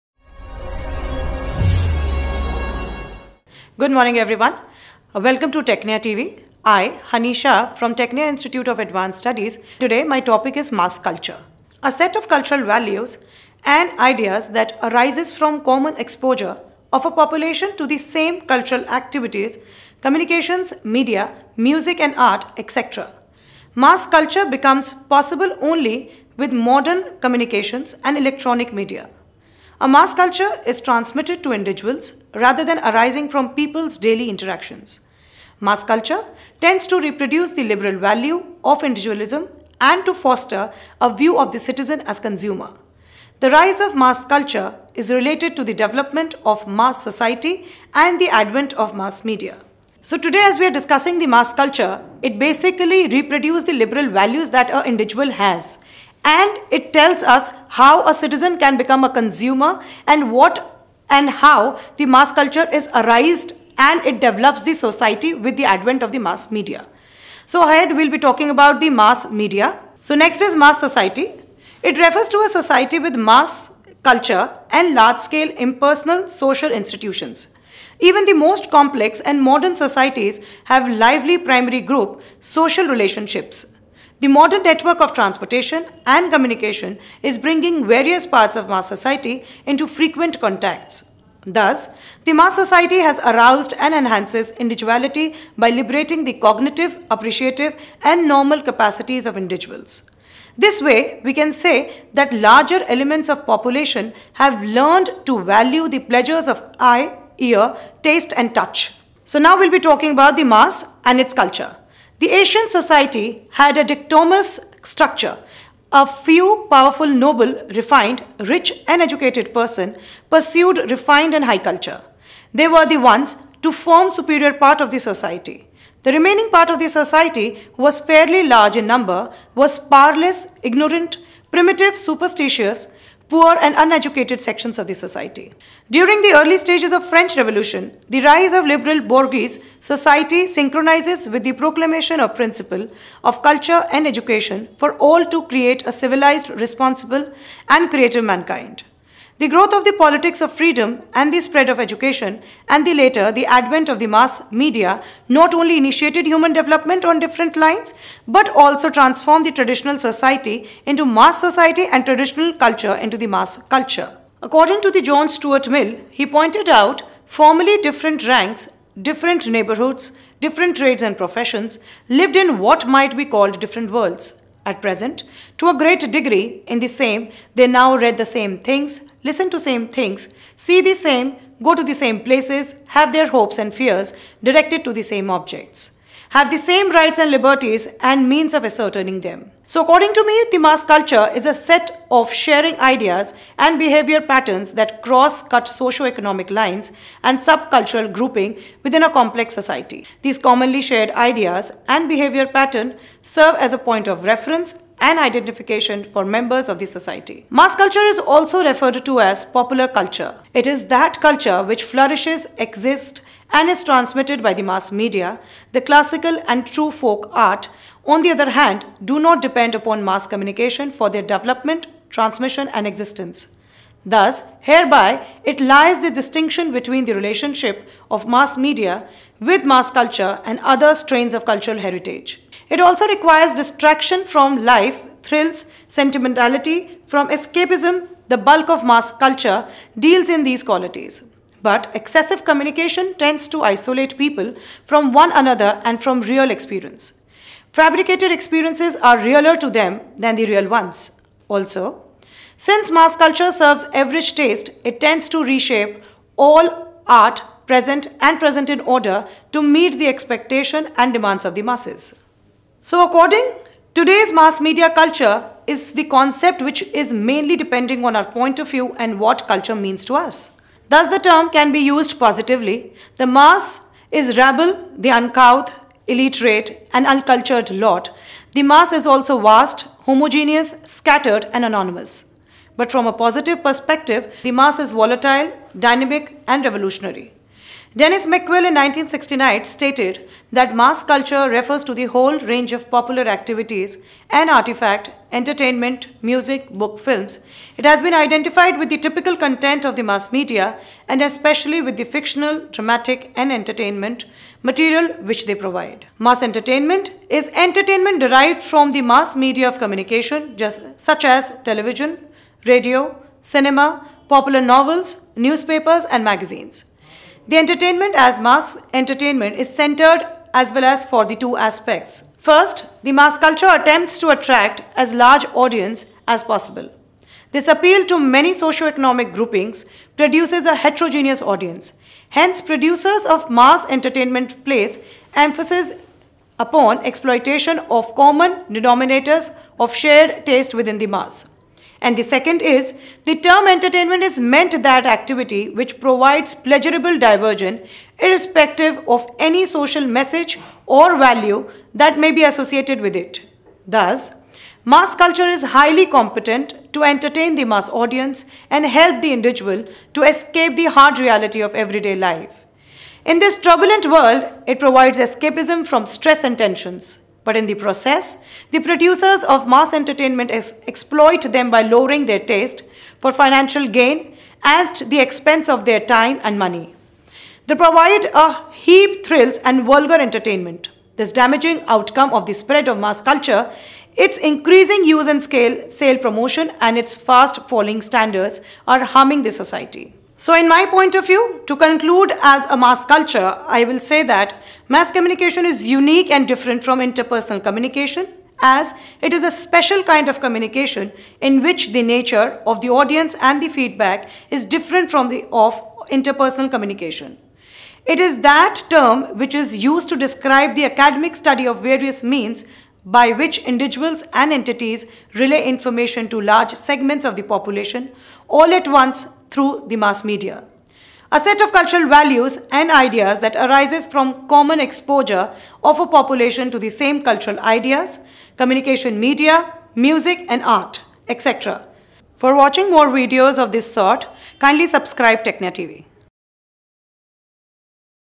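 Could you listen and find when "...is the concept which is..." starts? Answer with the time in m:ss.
4:25.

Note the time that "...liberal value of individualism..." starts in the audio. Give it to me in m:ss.
0:37.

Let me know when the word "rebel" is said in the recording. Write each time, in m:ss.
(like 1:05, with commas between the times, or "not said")
not said.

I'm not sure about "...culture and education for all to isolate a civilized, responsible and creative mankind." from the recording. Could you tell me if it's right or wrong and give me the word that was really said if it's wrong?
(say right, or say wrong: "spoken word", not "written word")
wrong: "create", not "isolate".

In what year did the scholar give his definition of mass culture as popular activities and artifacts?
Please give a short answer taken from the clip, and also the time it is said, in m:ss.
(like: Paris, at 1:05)
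1969, at 4:48.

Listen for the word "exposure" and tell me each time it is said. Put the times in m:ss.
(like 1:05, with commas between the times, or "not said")
0:15, 7:04.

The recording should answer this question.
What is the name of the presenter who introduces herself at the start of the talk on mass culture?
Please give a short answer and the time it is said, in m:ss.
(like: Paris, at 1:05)
Honey Shah, at 0:07.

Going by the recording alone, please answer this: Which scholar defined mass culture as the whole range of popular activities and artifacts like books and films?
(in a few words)
Denis McQuail.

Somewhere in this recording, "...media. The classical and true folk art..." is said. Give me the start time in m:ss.
3:34.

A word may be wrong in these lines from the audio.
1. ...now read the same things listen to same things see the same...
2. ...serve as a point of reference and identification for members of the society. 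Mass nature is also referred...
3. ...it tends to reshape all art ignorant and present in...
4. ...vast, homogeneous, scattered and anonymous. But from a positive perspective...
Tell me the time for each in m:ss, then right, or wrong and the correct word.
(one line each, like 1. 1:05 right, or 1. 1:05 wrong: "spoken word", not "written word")
1. 2:57 right
2. 3:23 wrong: "culture", not "nature"
3. 4:14 wrong: "present", not "ignorant"
4. 4:39 right.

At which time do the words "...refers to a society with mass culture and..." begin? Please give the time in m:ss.
1:11.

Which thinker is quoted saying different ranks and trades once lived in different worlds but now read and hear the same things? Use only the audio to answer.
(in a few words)
John Stuart Mill.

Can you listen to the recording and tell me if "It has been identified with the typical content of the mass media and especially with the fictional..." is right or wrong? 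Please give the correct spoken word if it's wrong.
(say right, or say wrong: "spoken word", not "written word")
right.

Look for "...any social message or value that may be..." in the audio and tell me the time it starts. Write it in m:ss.
5:49.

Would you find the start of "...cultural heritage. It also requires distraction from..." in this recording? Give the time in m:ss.
3:51.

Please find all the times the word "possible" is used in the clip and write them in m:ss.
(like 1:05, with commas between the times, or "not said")
0:24, 5:26.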